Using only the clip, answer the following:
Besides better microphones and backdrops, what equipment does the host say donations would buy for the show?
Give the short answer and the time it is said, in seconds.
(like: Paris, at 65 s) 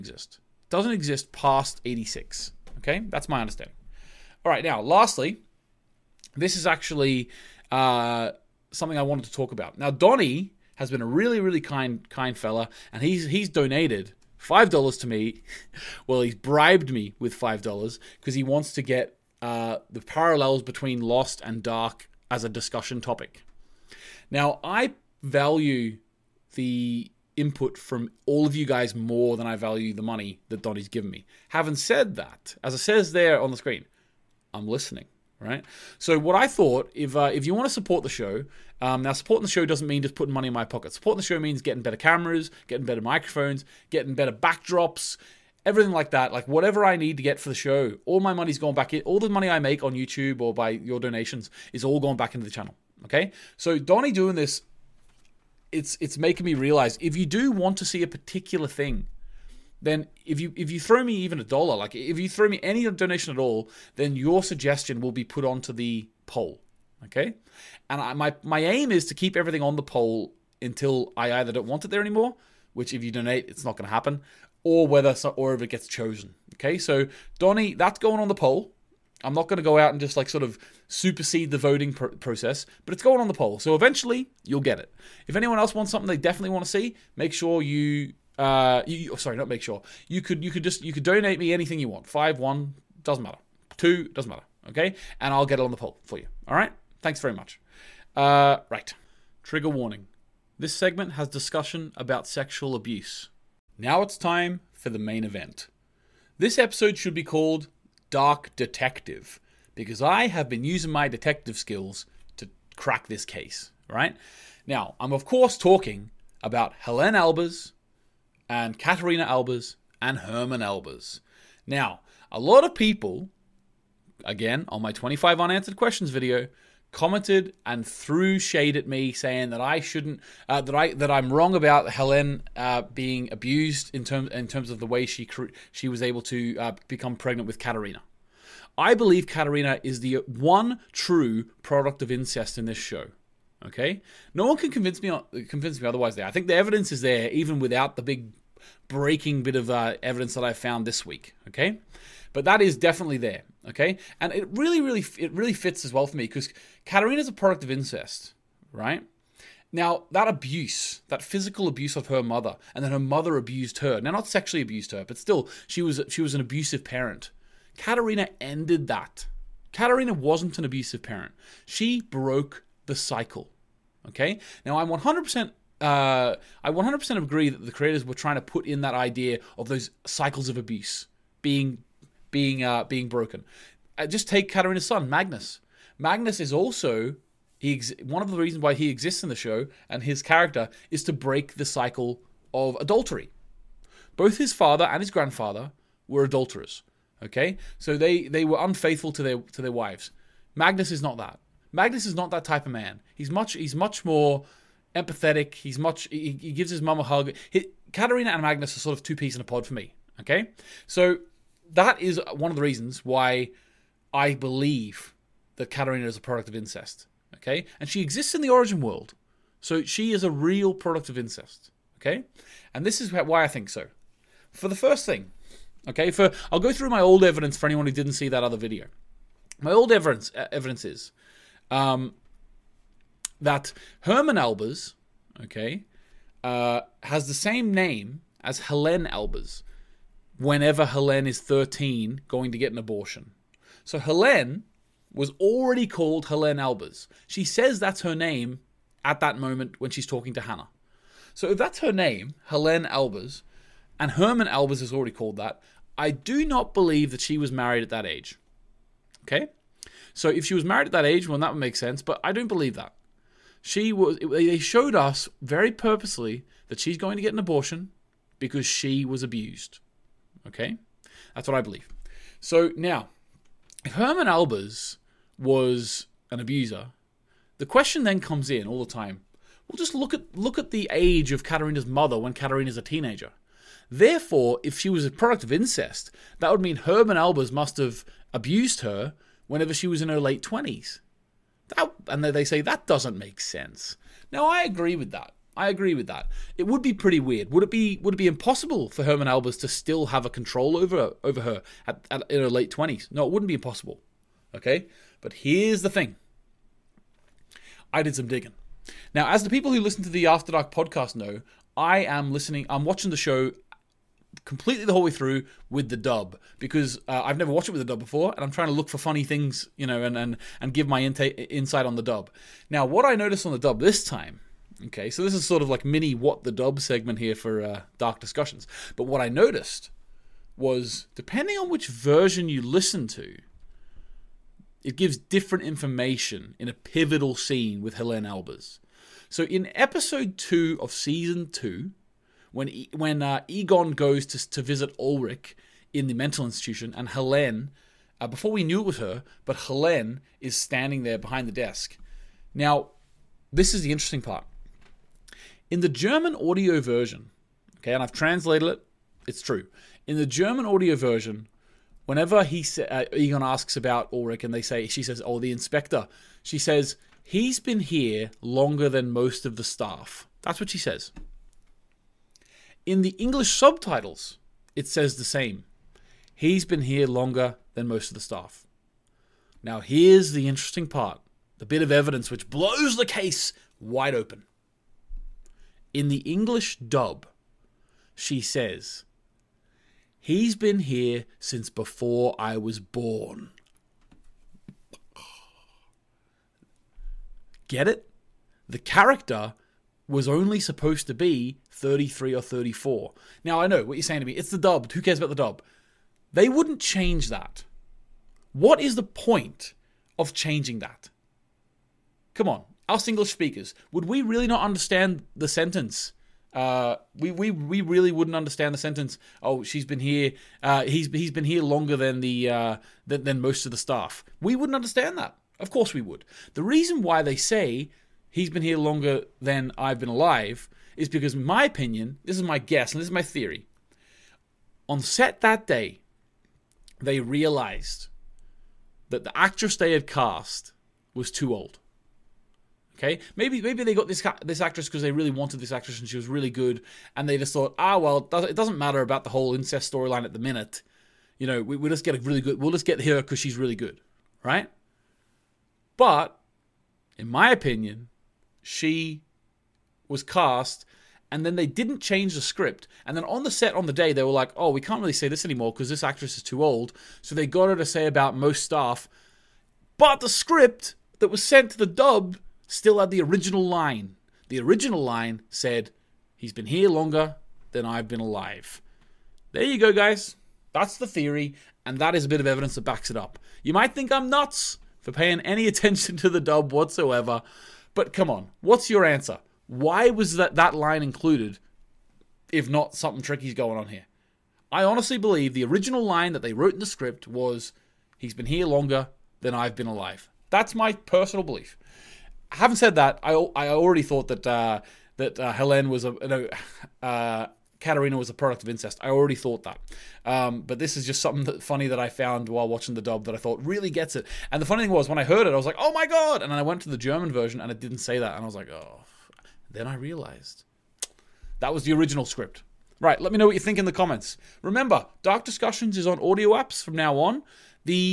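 better cameras, at 41 s.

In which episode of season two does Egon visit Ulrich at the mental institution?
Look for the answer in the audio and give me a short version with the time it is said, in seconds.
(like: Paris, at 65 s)
episode 2, at 339 s.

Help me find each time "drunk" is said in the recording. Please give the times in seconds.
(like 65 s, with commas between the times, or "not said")
not said.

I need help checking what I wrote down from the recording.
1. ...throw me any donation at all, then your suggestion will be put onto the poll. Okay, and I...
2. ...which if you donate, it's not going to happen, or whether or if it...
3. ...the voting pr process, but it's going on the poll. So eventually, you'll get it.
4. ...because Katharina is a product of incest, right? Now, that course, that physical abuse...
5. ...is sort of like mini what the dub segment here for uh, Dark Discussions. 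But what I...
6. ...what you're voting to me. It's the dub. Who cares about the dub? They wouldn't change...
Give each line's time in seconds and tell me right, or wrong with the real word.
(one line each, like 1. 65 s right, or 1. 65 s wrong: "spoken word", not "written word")
1. 62 s right
2. 72 s right
3. 81 s right
4. 156 s wrong: "abuse", not "course"
5. 325 s right
6. 403 s wrong: "saying", not "voting".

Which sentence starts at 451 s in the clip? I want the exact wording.
You know, we, we'll just get a really good.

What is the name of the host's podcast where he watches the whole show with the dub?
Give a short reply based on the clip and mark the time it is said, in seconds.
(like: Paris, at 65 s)
After Dark, at 310 s.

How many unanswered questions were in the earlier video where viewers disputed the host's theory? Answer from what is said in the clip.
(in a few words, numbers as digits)
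25.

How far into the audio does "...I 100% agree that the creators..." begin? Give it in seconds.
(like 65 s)
176 s.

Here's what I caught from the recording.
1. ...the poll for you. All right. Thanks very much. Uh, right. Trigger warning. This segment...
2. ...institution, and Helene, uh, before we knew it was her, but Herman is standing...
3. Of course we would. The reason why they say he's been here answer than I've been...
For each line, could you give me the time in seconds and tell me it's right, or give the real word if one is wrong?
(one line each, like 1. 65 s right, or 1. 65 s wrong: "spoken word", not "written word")
1. 95 s right
2. 346 s wrong: "Helene", not "Herman"
3. 425 s wrong: "longer", not "answer".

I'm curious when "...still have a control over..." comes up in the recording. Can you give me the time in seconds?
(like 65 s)
299 s.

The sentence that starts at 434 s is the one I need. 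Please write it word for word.
On set that day, they realized that the actress they had cast was too old.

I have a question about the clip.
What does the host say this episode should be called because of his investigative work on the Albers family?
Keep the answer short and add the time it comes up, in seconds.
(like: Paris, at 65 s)
Dark Detective, at 108 s.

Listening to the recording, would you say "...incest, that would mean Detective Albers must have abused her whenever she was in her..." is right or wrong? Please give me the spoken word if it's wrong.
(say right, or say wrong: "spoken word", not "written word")
wrong: "Herman", not "Detective".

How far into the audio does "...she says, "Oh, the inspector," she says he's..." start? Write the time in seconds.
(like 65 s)
364 s.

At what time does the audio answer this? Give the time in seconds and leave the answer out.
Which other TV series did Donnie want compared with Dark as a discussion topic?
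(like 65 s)
21 s.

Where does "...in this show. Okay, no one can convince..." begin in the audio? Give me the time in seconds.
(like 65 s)
142 s.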